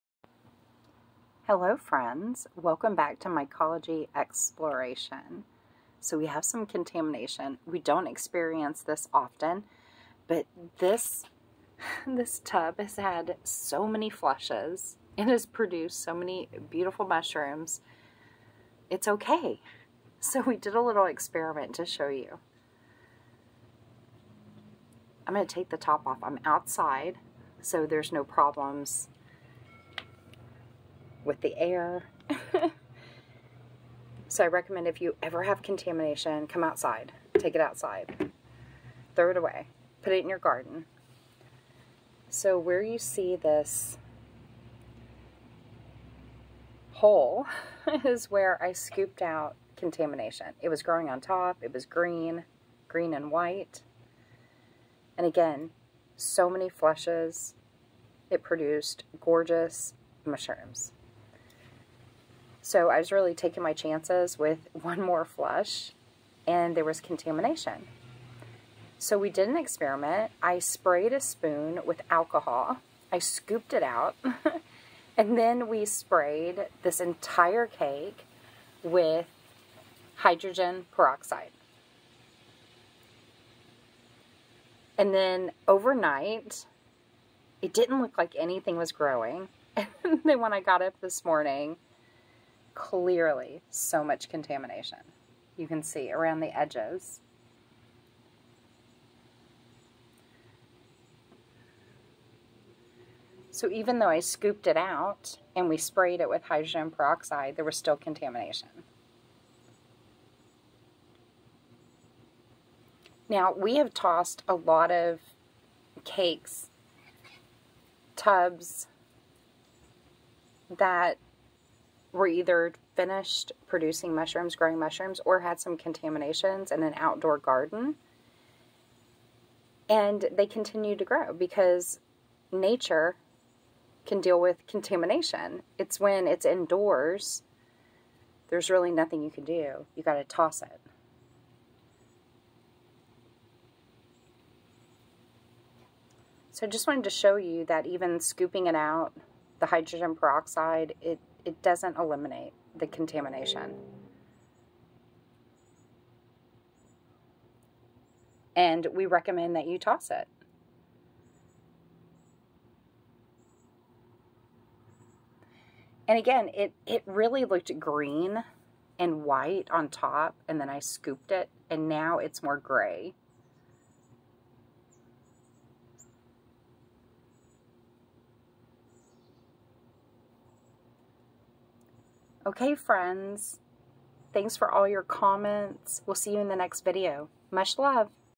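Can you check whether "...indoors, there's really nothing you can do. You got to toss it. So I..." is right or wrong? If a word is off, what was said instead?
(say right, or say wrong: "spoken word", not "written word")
right.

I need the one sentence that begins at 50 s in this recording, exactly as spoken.
It was growing on top, it was green, green and white.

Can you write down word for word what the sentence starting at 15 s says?
It has produced so many beautiful mushrooms.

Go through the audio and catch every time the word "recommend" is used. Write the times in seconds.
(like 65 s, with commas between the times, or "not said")
34 s, 159 s.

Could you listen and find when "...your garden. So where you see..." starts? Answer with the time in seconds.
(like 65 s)
40 s.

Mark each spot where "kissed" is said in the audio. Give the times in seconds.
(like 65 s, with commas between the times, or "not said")
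not said.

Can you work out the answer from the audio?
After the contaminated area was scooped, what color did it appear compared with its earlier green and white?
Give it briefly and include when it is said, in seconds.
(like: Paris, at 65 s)
gray, at 172 s.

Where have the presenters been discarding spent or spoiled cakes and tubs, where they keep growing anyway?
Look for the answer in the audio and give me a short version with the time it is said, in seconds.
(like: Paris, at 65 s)
an outdoor garden, at 126 s.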